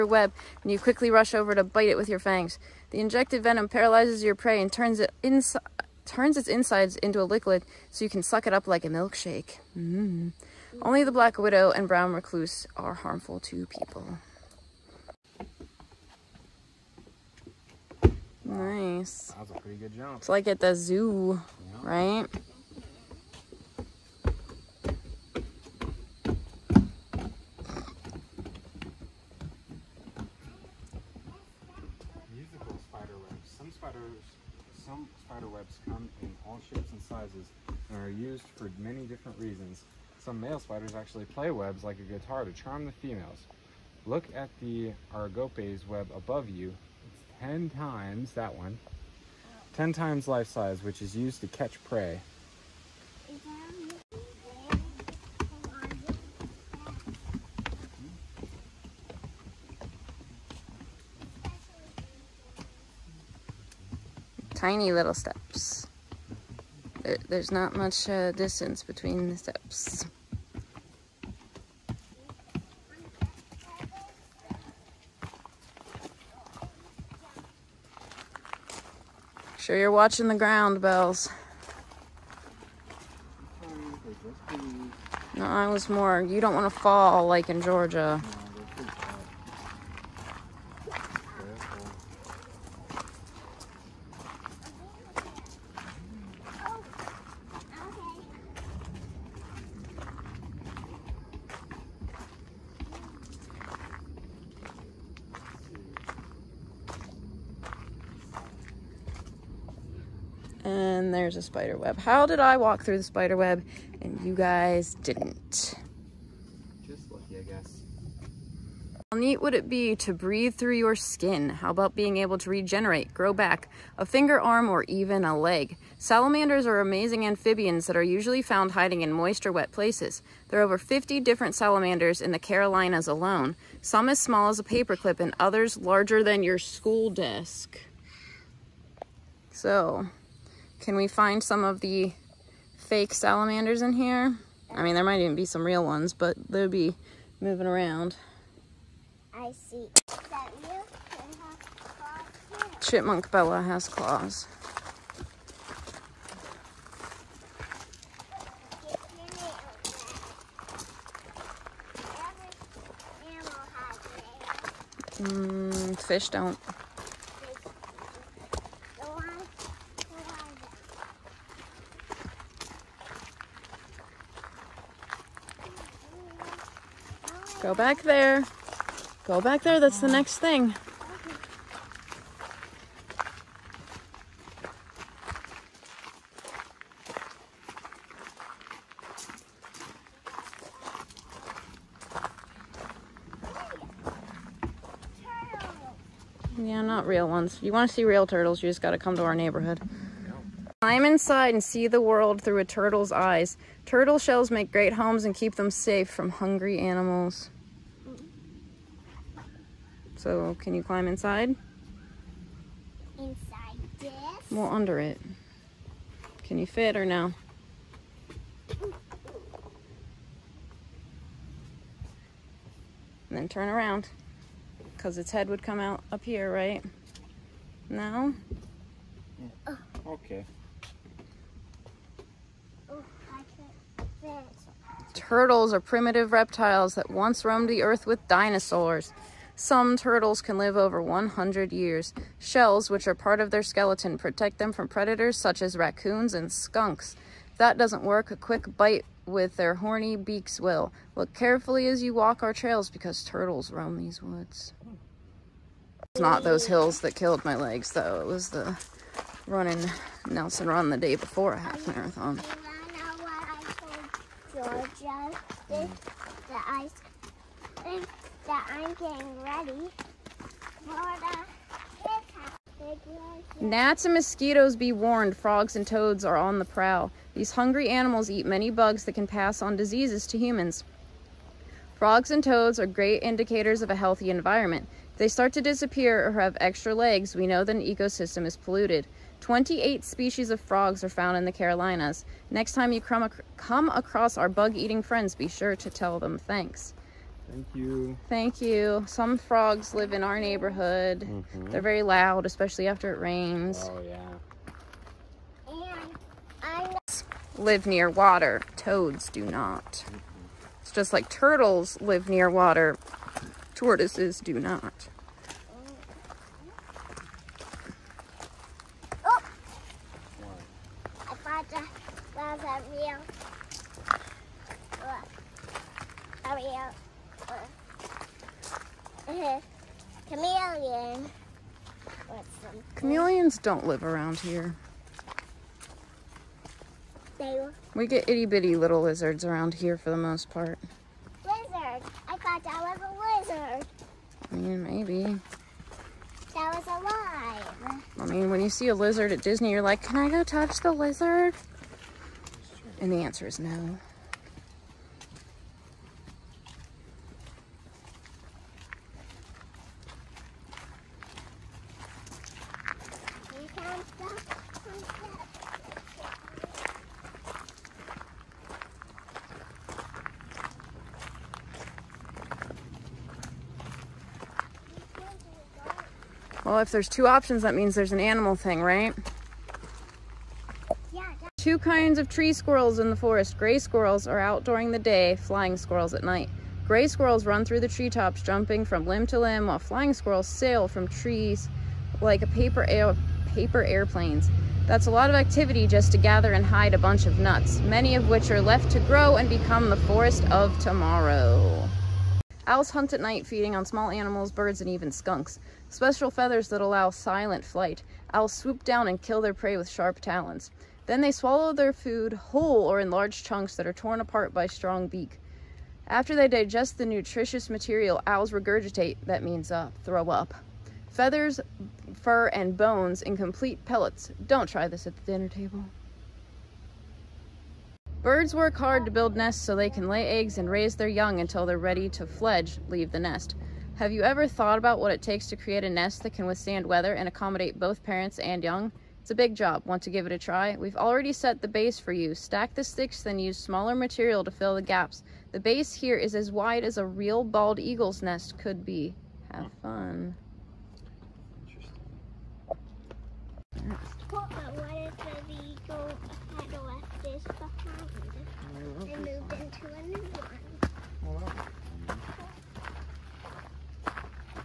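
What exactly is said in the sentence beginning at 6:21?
Two kinds of tree squirrels in the forest.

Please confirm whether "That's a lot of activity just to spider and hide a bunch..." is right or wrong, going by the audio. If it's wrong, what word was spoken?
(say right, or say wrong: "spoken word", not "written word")
wrong: "gather", not "spider".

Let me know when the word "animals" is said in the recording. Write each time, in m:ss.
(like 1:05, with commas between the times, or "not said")
3:26, 4:37, 6:18, 6:44.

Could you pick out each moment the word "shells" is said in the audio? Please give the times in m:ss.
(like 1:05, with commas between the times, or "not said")
3:24, 4:02.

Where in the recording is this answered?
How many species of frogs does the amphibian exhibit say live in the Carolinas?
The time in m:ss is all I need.
4:49.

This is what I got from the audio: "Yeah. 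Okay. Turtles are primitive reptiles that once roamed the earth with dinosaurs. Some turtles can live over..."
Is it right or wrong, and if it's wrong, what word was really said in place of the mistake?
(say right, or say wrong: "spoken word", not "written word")
right.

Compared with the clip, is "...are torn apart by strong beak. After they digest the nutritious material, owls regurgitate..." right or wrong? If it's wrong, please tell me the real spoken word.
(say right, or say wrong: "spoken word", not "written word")
right.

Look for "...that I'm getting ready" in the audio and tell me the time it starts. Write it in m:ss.
4:28.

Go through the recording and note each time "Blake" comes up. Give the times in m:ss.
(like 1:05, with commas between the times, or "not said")
not said.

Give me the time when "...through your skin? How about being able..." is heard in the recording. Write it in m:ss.
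2:00.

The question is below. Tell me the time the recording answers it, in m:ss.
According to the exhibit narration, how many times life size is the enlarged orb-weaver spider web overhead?
0:49.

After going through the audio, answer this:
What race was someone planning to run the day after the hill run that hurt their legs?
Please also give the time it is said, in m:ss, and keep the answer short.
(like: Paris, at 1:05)
a half marathon, at 4:21.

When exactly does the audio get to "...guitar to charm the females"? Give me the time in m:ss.
0:42.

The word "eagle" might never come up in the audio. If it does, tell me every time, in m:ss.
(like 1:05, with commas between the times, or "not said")
7:27, 7:35.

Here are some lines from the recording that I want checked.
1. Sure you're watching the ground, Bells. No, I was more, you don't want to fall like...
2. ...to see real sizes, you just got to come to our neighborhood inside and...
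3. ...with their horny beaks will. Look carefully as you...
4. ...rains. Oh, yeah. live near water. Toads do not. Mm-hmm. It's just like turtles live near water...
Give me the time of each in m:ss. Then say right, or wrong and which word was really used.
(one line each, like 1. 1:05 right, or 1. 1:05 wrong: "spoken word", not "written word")
1. 1:19 right
2. 3:17 wrong: "turtles", not "sizes"
3. 4:09 right
4. 5:03 right.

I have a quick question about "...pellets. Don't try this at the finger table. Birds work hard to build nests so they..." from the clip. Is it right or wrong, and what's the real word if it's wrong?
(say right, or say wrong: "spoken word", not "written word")
wrong: "dinner", not "finger".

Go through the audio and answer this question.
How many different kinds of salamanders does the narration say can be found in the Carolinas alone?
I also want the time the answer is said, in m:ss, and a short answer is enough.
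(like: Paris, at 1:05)
over 50, at 2:10.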